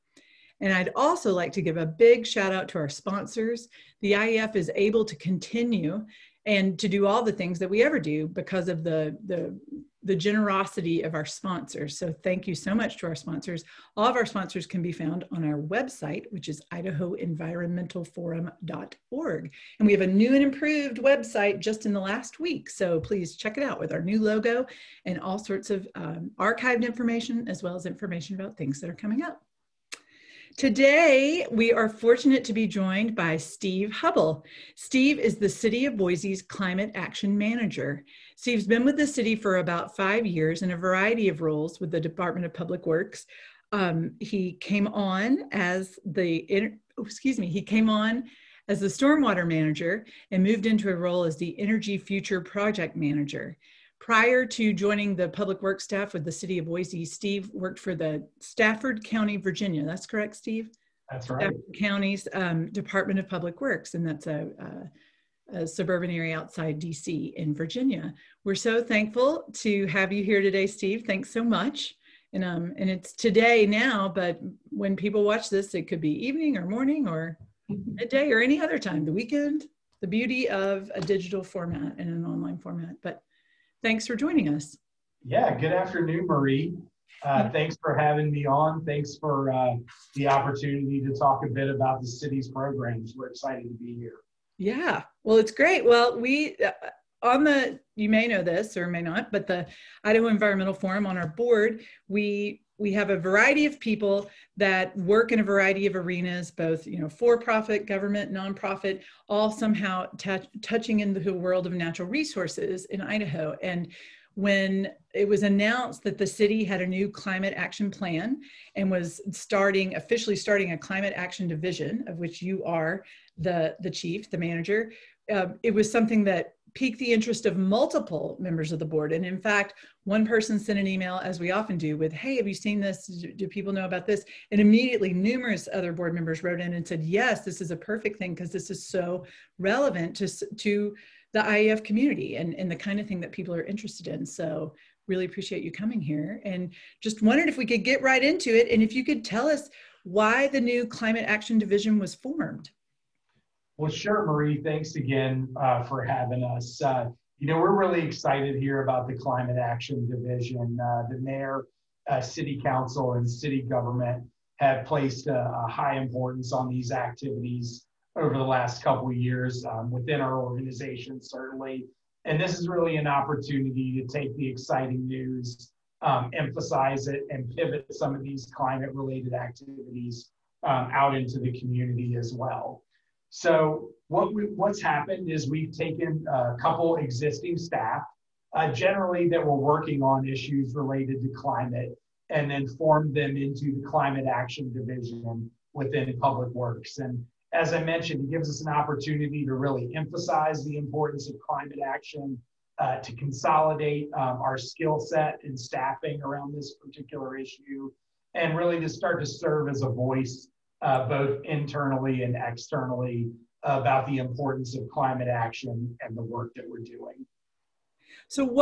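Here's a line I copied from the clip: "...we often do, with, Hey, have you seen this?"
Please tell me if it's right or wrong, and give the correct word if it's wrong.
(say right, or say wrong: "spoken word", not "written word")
right.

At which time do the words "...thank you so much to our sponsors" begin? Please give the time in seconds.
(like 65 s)
12 s.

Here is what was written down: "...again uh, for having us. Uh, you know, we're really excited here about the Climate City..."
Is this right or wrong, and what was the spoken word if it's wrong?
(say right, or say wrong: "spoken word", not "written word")
wrong: "Action", not "City".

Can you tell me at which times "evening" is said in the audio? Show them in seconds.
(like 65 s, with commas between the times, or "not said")
76 s.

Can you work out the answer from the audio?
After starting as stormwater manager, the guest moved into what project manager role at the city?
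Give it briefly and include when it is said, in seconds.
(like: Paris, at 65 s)
Energy Future Project Manager, at 51 s.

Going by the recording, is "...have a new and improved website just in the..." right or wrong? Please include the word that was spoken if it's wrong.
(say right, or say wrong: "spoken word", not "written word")
right.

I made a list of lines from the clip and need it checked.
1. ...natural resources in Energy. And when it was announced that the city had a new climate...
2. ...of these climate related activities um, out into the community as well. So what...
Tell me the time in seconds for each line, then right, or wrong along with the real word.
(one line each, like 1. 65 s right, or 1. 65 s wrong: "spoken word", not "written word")
1. 111 s wrong: "Idaho", not "Energy"
2. 178 s right.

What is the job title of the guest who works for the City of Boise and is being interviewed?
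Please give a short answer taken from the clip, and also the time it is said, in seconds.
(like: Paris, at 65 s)
Climate Action Manager, at 36 s.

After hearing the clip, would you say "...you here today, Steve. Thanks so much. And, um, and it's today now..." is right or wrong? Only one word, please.
right.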